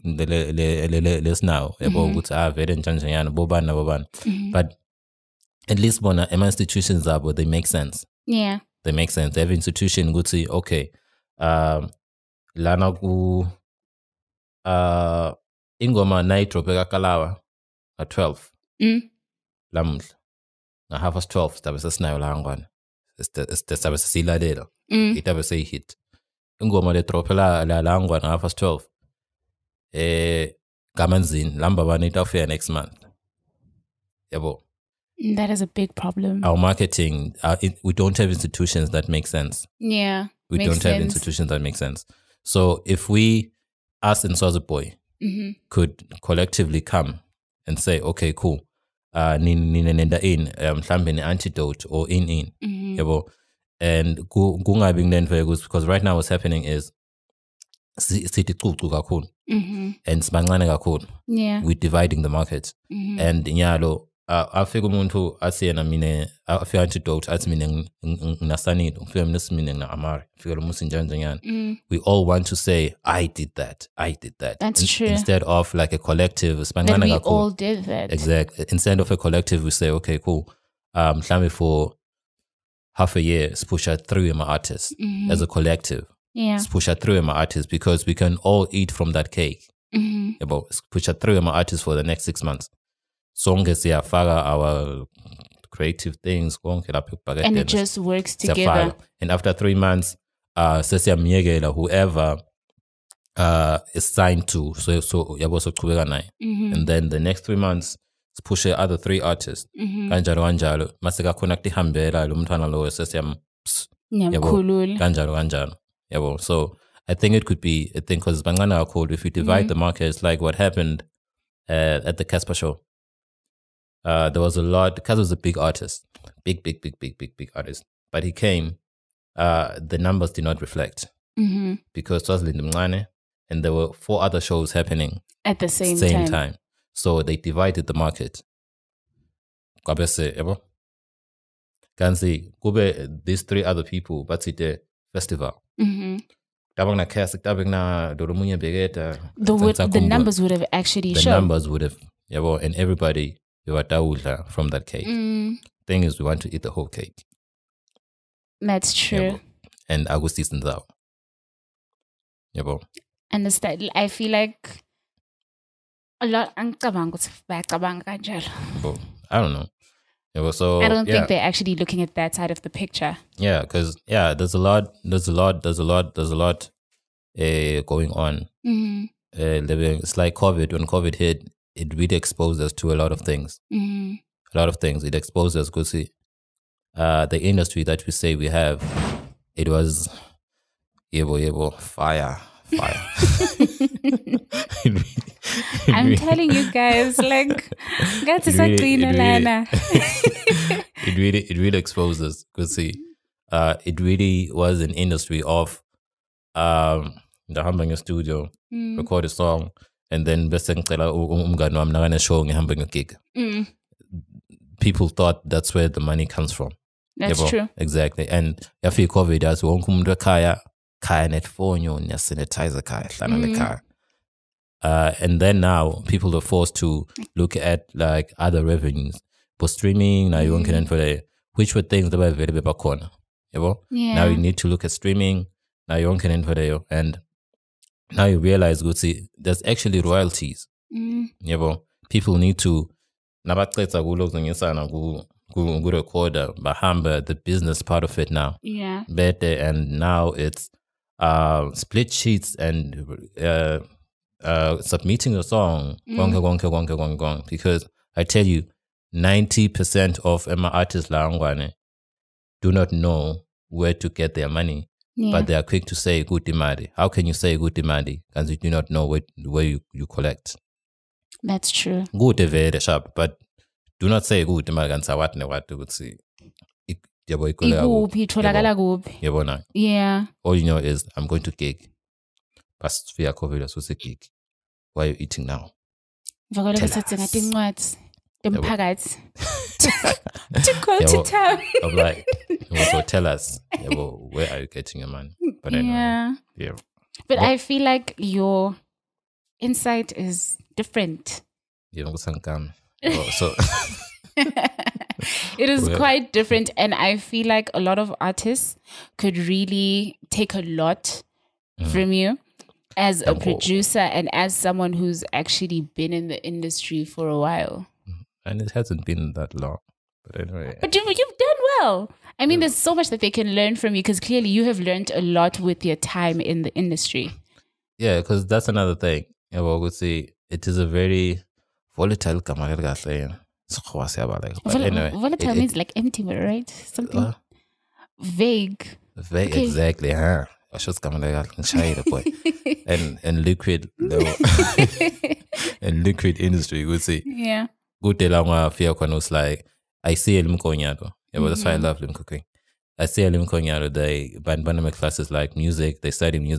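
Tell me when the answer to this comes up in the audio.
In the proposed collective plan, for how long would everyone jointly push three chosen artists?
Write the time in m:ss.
1:32.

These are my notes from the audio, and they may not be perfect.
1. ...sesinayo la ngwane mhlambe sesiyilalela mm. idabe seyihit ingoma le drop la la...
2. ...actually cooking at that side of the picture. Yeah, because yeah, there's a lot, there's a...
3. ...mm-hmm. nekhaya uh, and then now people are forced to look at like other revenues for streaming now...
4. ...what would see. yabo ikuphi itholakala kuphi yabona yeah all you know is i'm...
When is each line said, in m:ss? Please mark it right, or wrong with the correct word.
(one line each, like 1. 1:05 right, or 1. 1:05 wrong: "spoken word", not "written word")
1. 0:21 wrong: "sidabe", not "mhlambe"
2. 2:51 wrong: "looking", not "cooking"
3. 3:43 right
4. 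4:35 right.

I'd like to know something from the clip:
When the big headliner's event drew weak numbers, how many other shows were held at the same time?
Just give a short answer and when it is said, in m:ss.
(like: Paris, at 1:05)
four, at 2:13.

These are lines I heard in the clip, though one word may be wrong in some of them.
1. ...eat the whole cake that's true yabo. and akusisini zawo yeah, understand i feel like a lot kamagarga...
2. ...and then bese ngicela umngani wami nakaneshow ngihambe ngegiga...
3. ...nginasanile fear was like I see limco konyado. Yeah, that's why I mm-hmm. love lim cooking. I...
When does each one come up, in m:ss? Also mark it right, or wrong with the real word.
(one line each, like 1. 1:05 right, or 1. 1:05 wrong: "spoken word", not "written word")
1. 2:36 wrong: "angicabanga", not "kamagarga"
2. 3:30 right
3. 5:48 wrong: "while", not "nginasanile".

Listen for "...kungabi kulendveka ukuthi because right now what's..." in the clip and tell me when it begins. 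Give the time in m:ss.
0:54.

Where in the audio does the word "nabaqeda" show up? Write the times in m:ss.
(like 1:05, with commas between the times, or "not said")
4:03.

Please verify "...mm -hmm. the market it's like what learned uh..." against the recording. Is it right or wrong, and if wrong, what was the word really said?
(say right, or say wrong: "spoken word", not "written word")
wrong: "happened", not "learned".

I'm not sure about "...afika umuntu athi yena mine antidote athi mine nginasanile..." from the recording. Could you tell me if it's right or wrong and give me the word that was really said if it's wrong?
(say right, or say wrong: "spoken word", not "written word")
right.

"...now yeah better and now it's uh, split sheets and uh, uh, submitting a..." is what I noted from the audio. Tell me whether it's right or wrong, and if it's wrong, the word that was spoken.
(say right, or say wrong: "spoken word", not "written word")
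right.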